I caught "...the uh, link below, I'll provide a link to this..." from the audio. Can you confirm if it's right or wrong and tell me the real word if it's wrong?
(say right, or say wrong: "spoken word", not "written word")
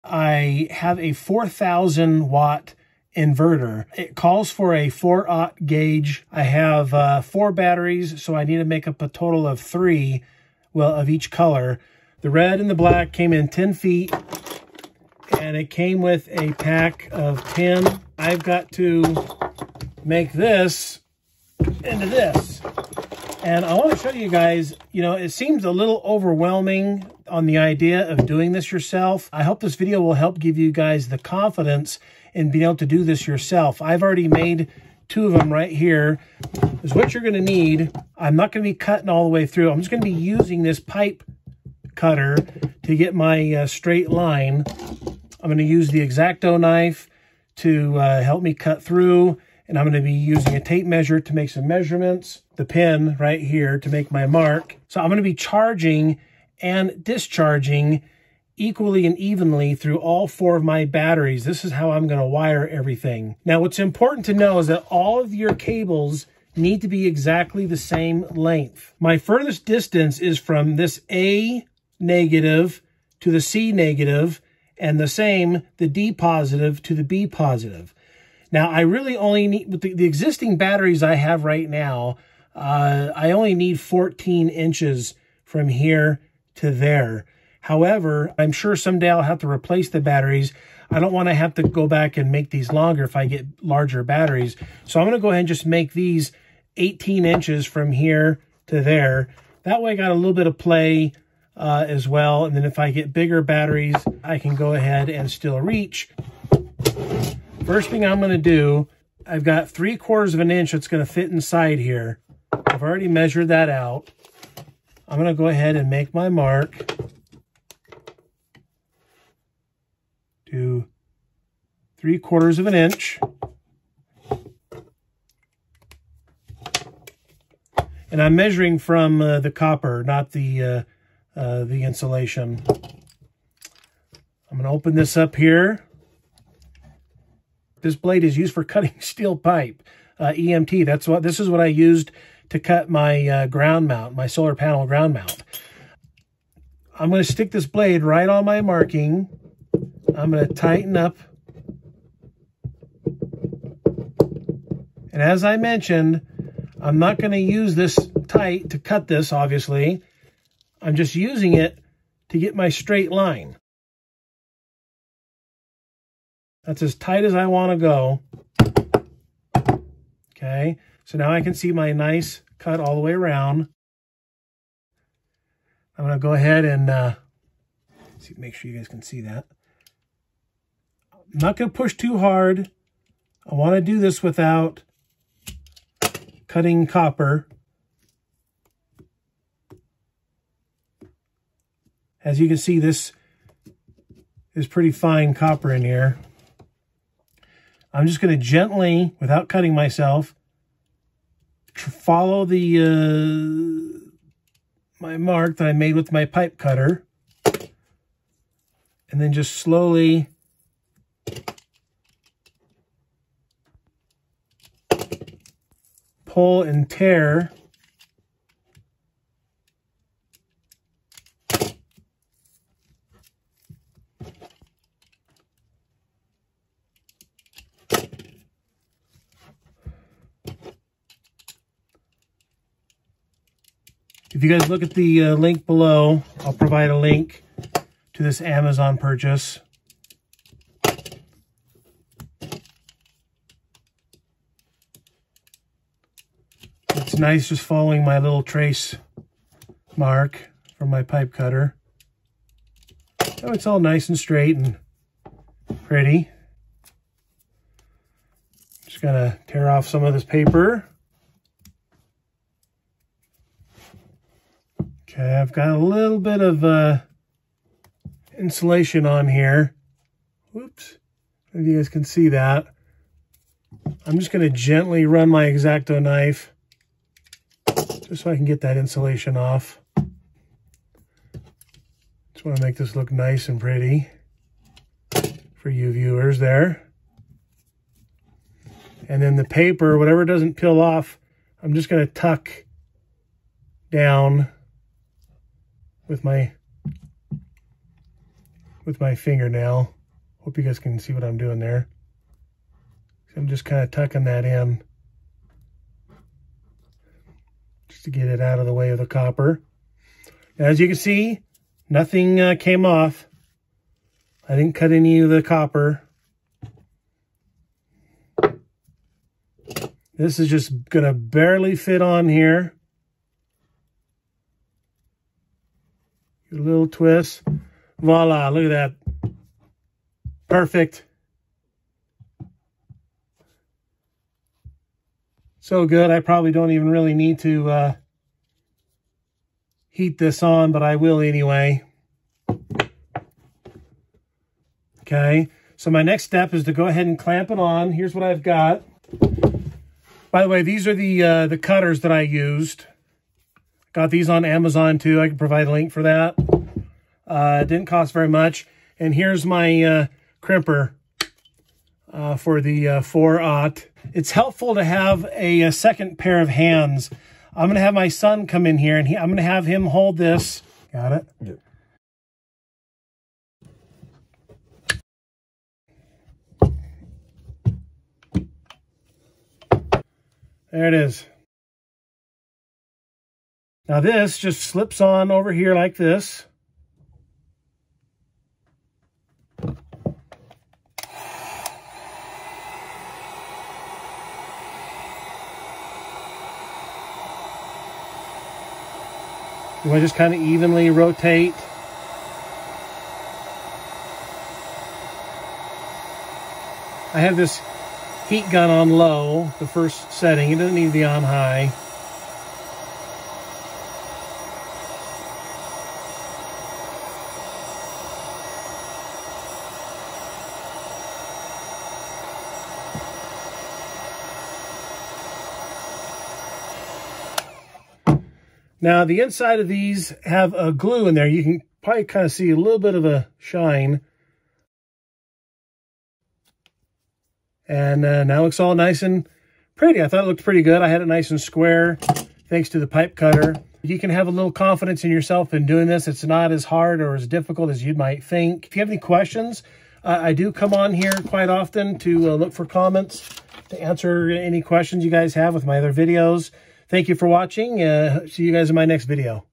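right.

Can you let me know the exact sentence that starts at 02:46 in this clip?
That's as tight as I want to go.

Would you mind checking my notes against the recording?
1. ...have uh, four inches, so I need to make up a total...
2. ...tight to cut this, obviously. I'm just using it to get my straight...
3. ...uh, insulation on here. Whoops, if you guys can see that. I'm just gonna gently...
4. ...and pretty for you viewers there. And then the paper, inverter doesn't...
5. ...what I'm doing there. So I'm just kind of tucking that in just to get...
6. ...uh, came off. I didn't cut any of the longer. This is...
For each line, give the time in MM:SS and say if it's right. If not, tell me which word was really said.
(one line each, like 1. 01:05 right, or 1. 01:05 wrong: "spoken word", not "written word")
1. 00:06 wrong: "batteries", not "inches"
2. 02:38 right
3. 04:26 right
4. 04:43 wrong: "whatever", not "inverter"
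5. 05:01 right
6. 05:12 wrong: "copper", not "longer".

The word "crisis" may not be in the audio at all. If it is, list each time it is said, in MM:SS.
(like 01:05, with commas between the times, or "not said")
not said.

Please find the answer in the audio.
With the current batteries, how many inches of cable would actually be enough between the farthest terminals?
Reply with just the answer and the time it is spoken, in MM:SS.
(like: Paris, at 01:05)
14 inches, at 01:23.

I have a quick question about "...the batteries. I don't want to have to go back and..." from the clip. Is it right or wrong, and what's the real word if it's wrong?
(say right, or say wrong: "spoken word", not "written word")
right.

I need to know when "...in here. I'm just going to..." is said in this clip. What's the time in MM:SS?
03:15.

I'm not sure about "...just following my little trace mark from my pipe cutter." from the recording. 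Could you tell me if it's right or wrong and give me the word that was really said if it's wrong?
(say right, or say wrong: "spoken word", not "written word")
right.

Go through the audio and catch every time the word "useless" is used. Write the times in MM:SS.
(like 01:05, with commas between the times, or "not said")
not said.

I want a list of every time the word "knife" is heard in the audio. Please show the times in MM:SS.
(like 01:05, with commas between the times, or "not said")
00:46, 04:36.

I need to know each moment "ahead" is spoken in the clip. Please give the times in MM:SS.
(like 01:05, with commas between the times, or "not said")
01:35, 01:44, 01:55, 02:56, 05:46.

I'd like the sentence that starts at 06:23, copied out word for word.
Now this just slips on over here like this.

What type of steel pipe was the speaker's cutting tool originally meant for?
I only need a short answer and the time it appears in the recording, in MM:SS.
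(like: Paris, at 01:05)
EMT, at 02:20.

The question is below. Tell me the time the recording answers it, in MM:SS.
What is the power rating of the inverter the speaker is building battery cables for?
00:01.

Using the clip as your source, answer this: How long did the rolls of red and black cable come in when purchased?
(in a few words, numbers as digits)
10 feet.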